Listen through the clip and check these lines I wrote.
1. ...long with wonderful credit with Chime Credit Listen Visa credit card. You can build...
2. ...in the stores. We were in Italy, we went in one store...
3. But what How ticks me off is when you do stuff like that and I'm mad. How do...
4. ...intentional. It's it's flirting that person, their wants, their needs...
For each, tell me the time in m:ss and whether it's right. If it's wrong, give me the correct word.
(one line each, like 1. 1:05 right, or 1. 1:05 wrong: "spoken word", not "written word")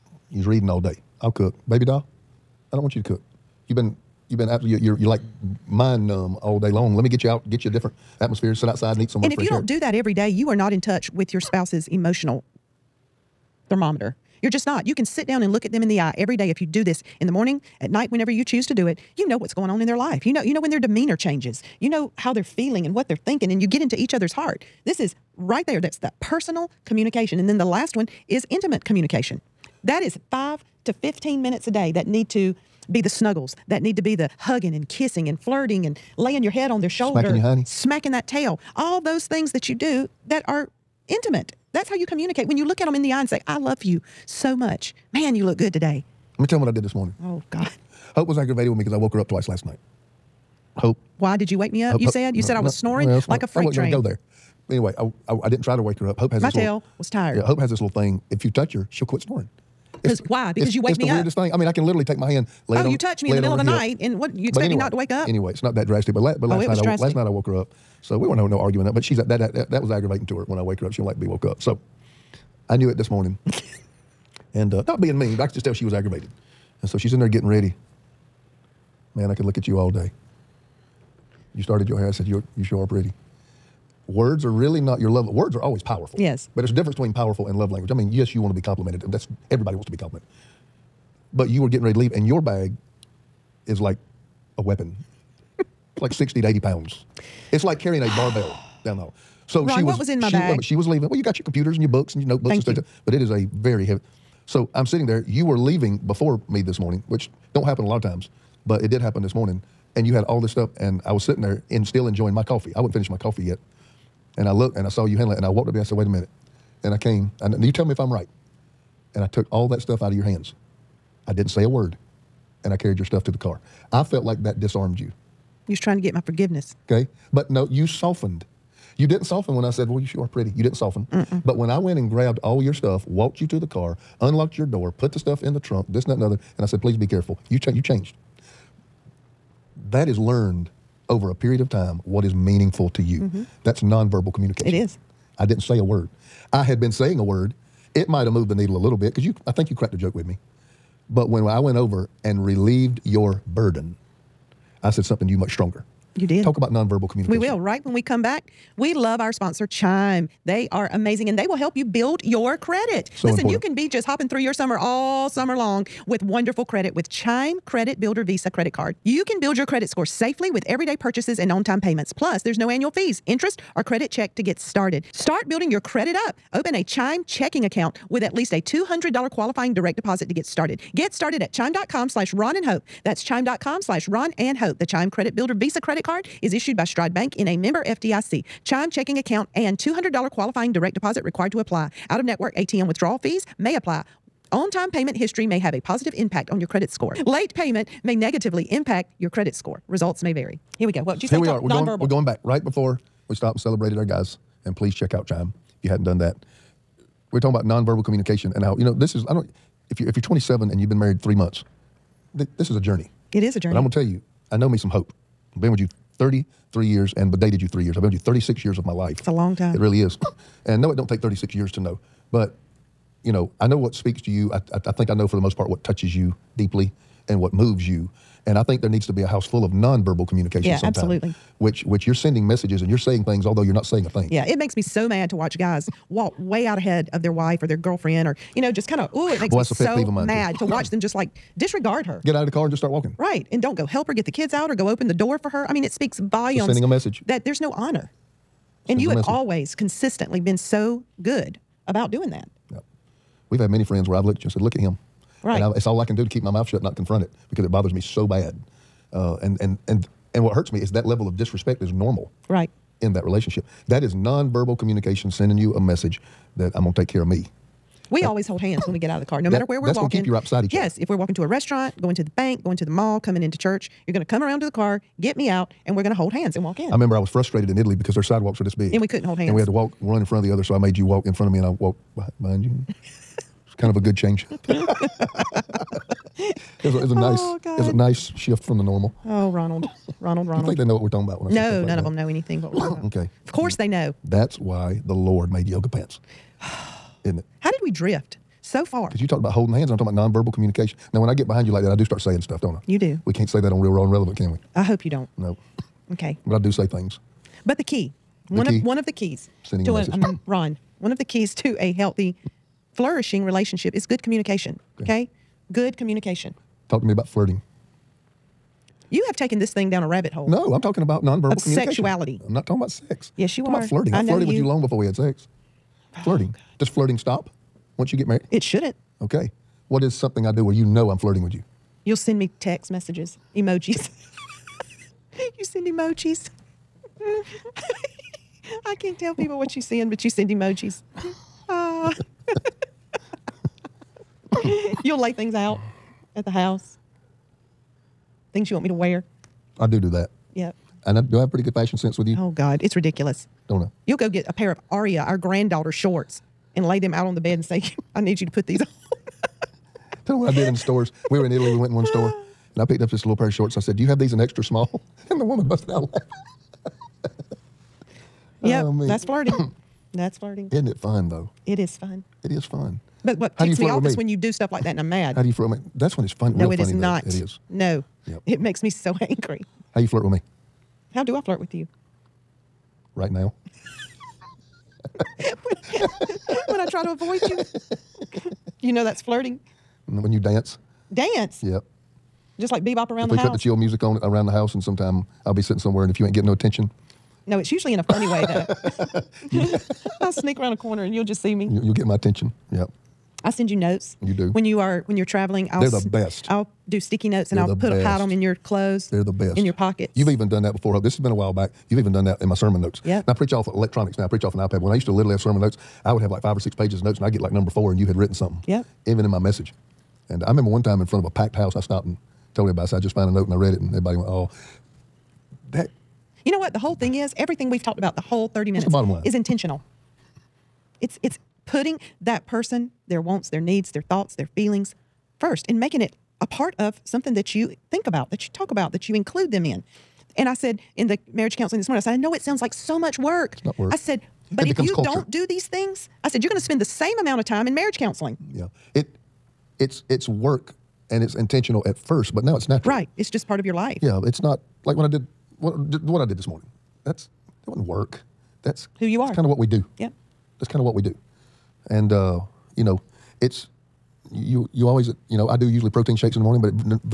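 1. 2:45 wrong: "Builder", not "Listen"
2. 6:00 right
3. 6:13 right
4. 7:09 wrong: "putting", not "flirting".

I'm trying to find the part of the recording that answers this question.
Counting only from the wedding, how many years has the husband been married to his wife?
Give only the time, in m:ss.
3:36.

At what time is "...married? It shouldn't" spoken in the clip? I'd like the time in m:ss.
5:28.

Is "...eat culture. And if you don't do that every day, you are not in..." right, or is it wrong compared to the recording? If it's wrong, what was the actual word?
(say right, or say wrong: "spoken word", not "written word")
wrong: "somewhere", not "culture".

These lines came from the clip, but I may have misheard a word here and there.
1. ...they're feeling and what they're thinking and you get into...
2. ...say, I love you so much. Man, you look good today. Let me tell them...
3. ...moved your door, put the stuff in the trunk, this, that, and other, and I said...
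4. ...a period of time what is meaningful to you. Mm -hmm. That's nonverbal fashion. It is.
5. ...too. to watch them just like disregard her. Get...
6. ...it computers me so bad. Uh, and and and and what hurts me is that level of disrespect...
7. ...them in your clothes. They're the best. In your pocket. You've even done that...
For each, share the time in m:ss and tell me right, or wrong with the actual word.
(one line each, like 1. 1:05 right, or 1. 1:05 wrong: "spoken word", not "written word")
1. 0:22 right
2. 0:43 right
3. 2:14 wrong: "unlocked", not "moved"
4. 2:21 wrong: "communication", not "fashion"
5. 4:00 right
6. 4:17 wrong: "bothers", not "computers"
7. 6:48 right.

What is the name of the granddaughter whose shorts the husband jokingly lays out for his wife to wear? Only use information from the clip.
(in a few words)
Aria.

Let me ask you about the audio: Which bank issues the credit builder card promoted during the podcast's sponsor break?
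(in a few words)
Stride Bank.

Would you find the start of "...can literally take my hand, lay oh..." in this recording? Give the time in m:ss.
1:01.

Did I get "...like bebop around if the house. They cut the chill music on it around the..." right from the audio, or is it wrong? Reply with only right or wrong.
right.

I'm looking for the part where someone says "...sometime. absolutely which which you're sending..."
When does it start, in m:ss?
3:50.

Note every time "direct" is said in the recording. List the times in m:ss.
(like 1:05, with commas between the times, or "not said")
2:59, 3:10.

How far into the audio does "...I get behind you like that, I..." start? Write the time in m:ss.
5:01.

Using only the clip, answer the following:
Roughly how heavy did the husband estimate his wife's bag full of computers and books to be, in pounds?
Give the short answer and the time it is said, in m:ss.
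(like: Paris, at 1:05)
60 to 80 pounds, at 1:36.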